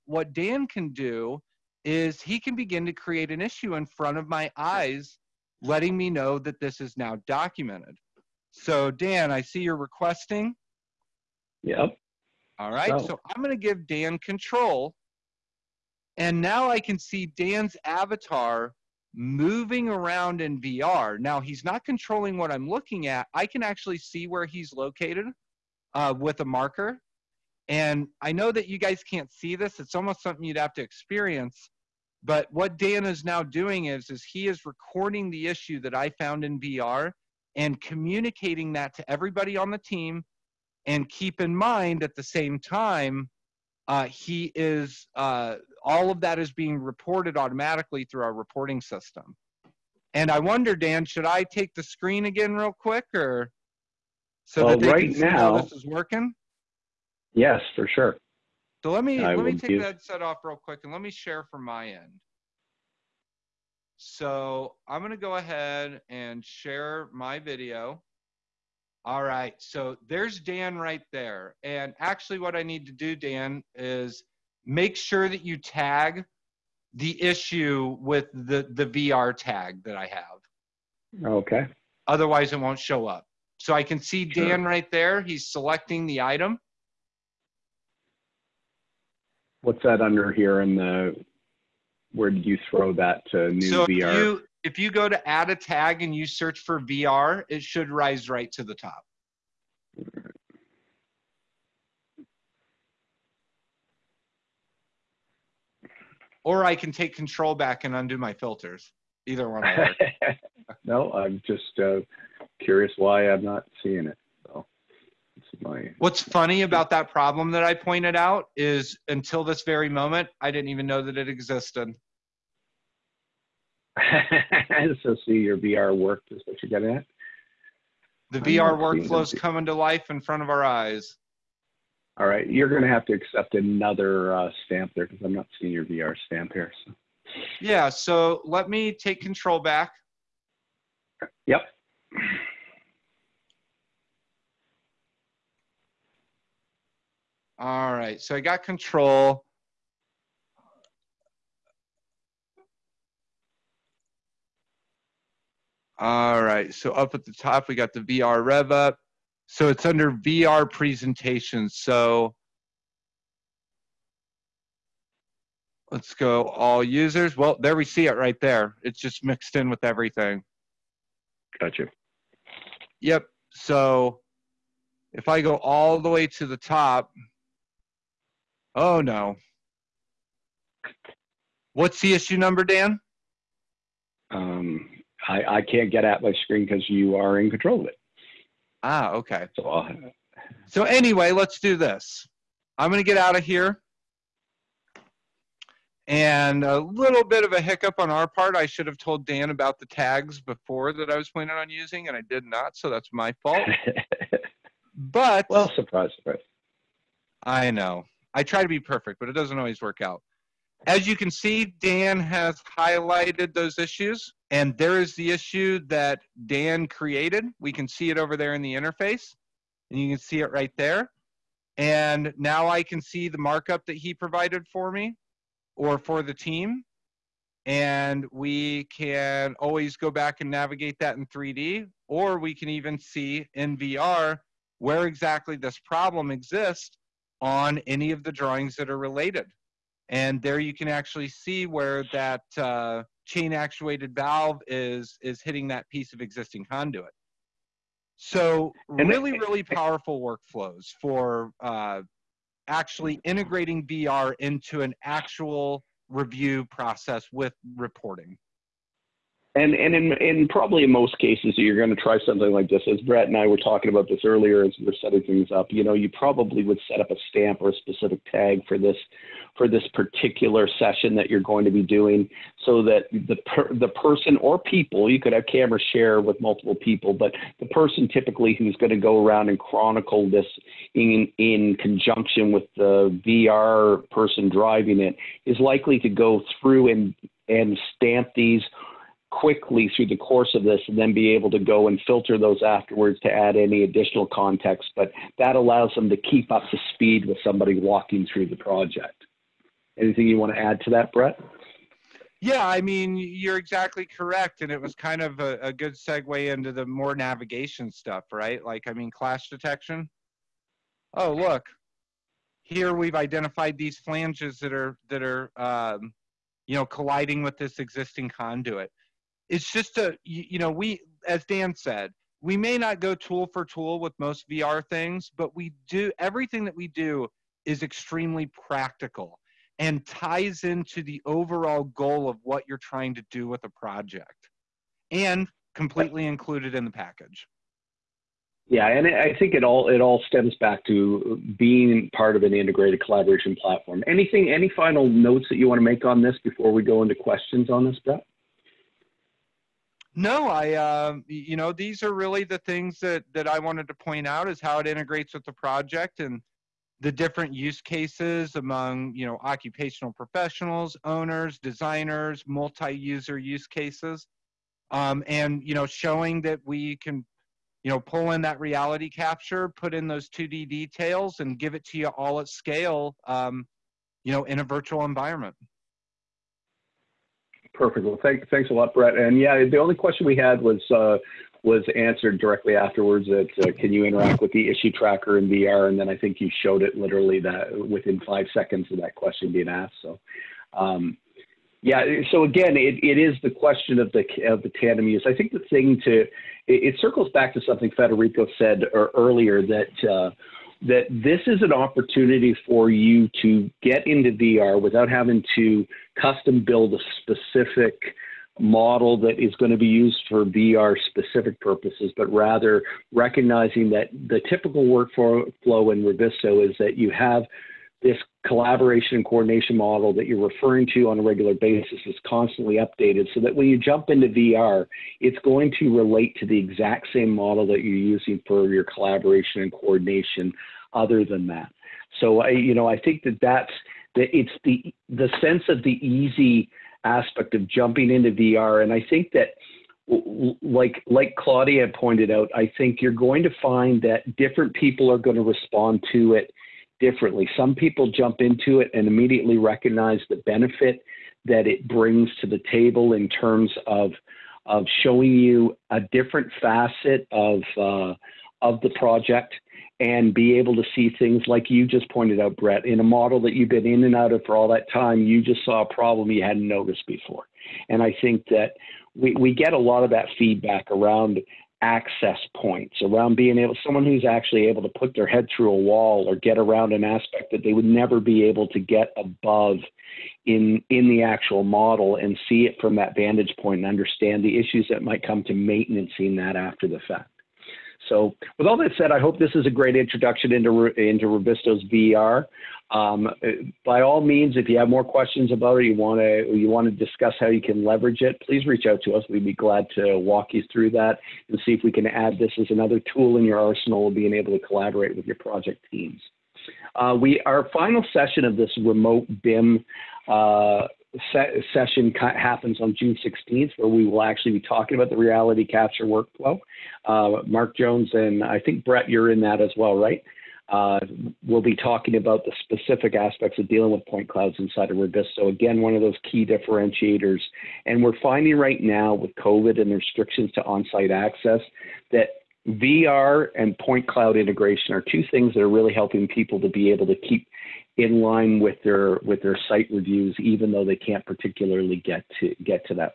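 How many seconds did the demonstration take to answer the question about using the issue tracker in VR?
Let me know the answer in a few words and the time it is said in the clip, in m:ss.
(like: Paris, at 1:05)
5, at 6:28.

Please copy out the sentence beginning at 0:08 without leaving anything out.
So, Dan, I see you're requesting.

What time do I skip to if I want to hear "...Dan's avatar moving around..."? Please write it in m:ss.
0:17.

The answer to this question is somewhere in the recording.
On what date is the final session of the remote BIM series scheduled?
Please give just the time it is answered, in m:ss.
8:32.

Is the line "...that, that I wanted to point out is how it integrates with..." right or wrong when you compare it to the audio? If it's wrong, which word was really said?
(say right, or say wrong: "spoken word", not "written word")
right.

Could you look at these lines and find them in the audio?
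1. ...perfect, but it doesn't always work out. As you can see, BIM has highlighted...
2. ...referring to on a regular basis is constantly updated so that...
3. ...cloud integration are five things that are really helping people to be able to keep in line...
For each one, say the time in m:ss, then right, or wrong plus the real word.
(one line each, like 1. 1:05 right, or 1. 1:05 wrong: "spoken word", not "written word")
1. 3:28 wrong: "Dan", not "BIM"
2. 7:00 right
3. 8:54 wrong: "two", not "five".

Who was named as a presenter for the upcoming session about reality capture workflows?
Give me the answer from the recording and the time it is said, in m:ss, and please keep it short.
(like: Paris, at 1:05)
Mark Jones, at 8:37.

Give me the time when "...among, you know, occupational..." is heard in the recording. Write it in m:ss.
5:58.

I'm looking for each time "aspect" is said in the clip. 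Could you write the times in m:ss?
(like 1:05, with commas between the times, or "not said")
7:17, 7:57, 8:43.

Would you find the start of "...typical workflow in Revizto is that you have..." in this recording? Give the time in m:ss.
6:54.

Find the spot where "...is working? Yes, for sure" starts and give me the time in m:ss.
0:55.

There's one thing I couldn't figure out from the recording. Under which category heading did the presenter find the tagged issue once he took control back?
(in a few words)
VR presentations.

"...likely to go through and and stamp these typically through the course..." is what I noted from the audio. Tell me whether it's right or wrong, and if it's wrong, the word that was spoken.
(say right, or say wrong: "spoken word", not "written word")
wrong: "quickly", not "typically".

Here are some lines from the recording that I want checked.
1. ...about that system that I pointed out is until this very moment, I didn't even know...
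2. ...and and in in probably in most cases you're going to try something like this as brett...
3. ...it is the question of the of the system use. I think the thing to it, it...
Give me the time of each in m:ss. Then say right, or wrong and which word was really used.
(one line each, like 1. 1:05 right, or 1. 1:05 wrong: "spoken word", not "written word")
1. 1:56 wrong: "problem", not "system"
2. 4:19 right
3. 6:33 wrong: "tandem", not "system".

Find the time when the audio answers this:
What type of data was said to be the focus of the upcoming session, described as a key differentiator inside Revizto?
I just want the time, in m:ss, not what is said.
8:44.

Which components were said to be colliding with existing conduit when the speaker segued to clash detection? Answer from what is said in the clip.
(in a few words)
flanges.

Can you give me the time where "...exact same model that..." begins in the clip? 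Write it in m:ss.
7:06.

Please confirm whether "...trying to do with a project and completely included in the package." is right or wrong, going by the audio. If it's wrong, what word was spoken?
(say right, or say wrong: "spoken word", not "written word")
right.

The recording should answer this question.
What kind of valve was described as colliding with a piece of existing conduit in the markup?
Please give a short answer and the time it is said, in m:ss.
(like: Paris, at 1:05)
chain actuated valve, at 4:03.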